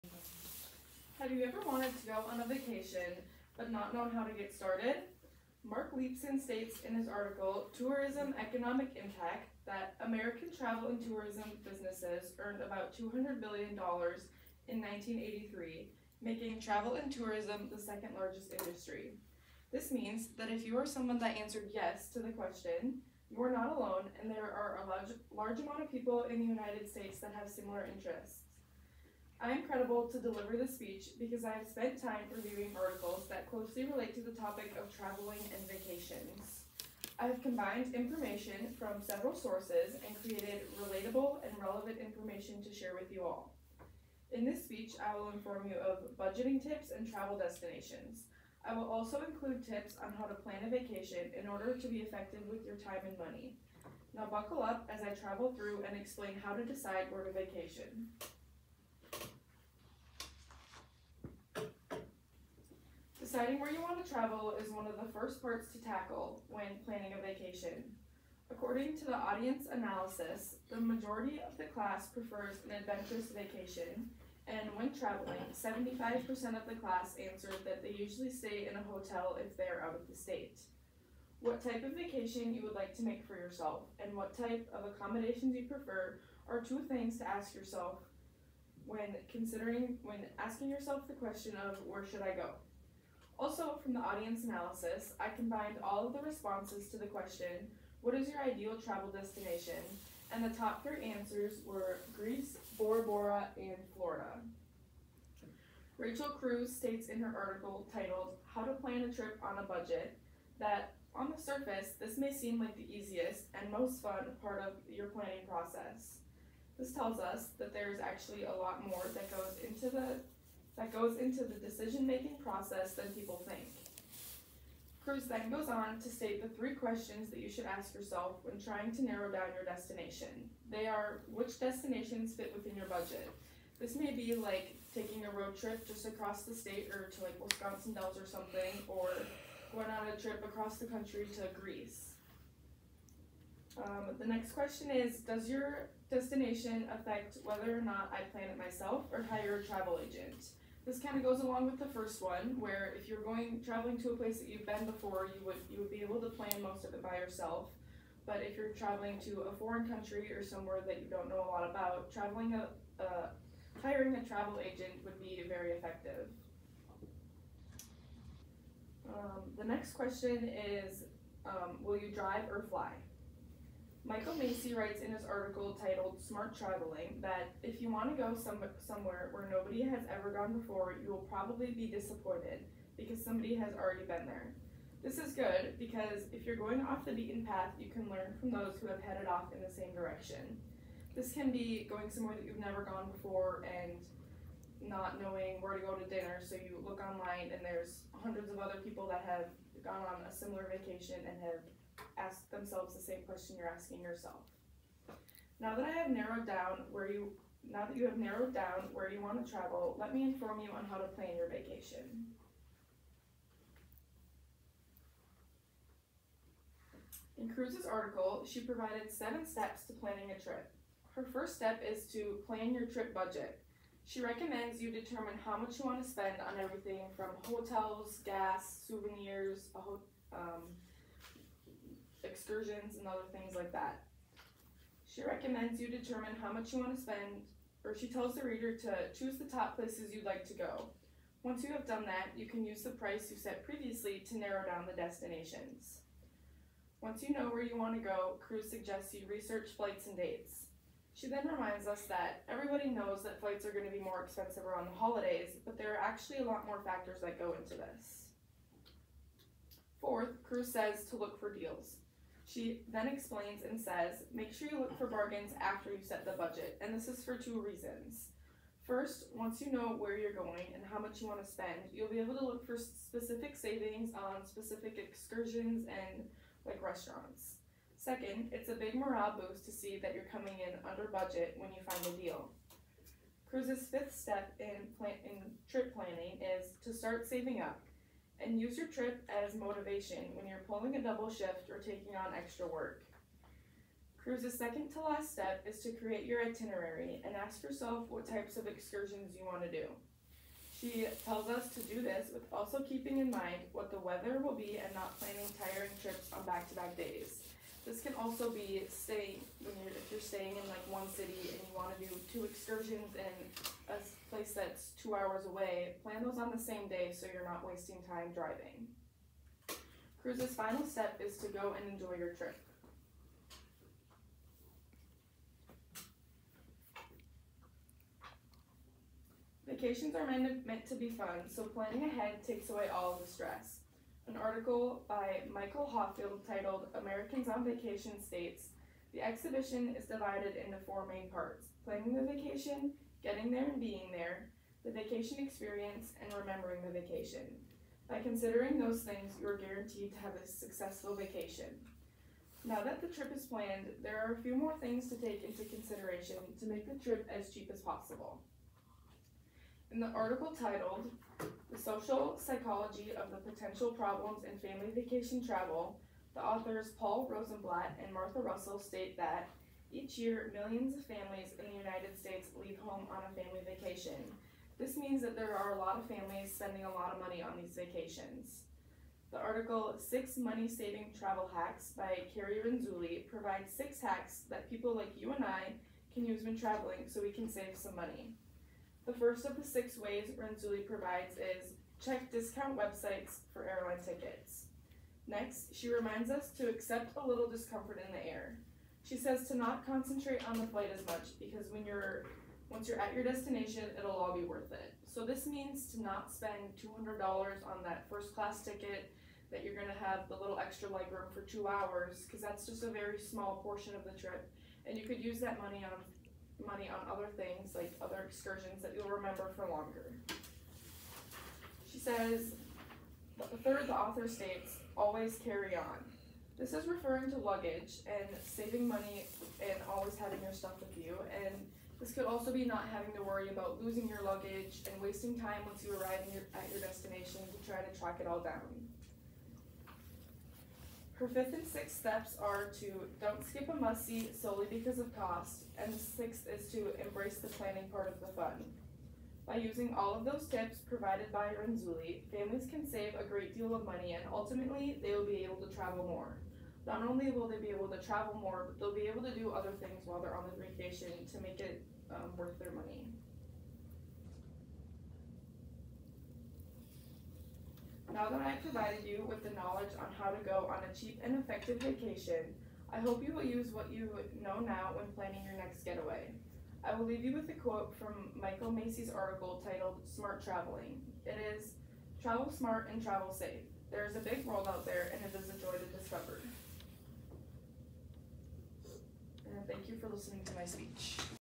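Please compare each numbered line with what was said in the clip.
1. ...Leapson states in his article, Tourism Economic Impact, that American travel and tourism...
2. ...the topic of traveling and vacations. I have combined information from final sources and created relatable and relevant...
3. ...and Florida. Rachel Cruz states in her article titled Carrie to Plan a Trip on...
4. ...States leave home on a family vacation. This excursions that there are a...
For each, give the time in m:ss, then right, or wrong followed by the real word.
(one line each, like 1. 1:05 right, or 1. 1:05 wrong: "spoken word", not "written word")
1. 0:05 right
2. 0:34 wrong: "several", not "final"
3. 1:43 wrong: "How", not "Carrie"
4. 6:12 wrong: "means", not "excursions".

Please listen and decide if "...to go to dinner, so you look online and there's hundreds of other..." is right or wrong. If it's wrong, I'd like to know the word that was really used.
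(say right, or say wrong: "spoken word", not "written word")
right.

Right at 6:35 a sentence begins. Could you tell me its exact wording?
Next, she reminds us to accept a little discomfort in the air.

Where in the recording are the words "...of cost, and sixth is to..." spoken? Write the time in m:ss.
7:24.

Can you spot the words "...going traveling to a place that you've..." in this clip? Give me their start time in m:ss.
2:33.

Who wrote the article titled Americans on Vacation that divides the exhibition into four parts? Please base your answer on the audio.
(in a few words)
Michael Hawfield.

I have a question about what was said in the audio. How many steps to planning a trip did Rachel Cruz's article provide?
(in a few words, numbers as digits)
7.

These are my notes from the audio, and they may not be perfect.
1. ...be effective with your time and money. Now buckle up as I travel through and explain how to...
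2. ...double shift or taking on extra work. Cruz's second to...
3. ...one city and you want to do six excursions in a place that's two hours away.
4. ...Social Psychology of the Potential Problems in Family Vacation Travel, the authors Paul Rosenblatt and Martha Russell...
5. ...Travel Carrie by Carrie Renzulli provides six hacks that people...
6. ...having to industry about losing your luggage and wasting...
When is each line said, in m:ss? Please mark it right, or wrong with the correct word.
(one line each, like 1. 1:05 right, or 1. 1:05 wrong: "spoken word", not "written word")
1. 0:51 right
2. 4:51 right
3. 5:10 wrong: "two", not "six"
4. 6:01 right
5. 6:21 wrong: "Hacks", not "Carrie"
6. 7:12 wrong: "worry", not "industry".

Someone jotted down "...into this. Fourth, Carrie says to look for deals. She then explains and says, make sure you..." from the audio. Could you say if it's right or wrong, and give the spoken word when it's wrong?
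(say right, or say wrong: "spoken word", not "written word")
wrong: "Cruz", not "Carrie".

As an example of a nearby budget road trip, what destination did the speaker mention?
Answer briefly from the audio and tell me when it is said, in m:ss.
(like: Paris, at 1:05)
Wisconsin Dells, at 2:17.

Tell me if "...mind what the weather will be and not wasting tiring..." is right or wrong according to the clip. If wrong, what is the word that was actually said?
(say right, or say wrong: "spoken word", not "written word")
wrong: "planning", not "wasting".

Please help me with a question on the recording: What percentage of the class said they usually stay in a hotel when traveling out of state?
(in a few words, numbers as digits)
75%.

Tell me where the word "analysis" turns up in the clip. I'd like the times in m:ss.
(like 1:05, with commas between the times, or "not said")
1:09, 1:34.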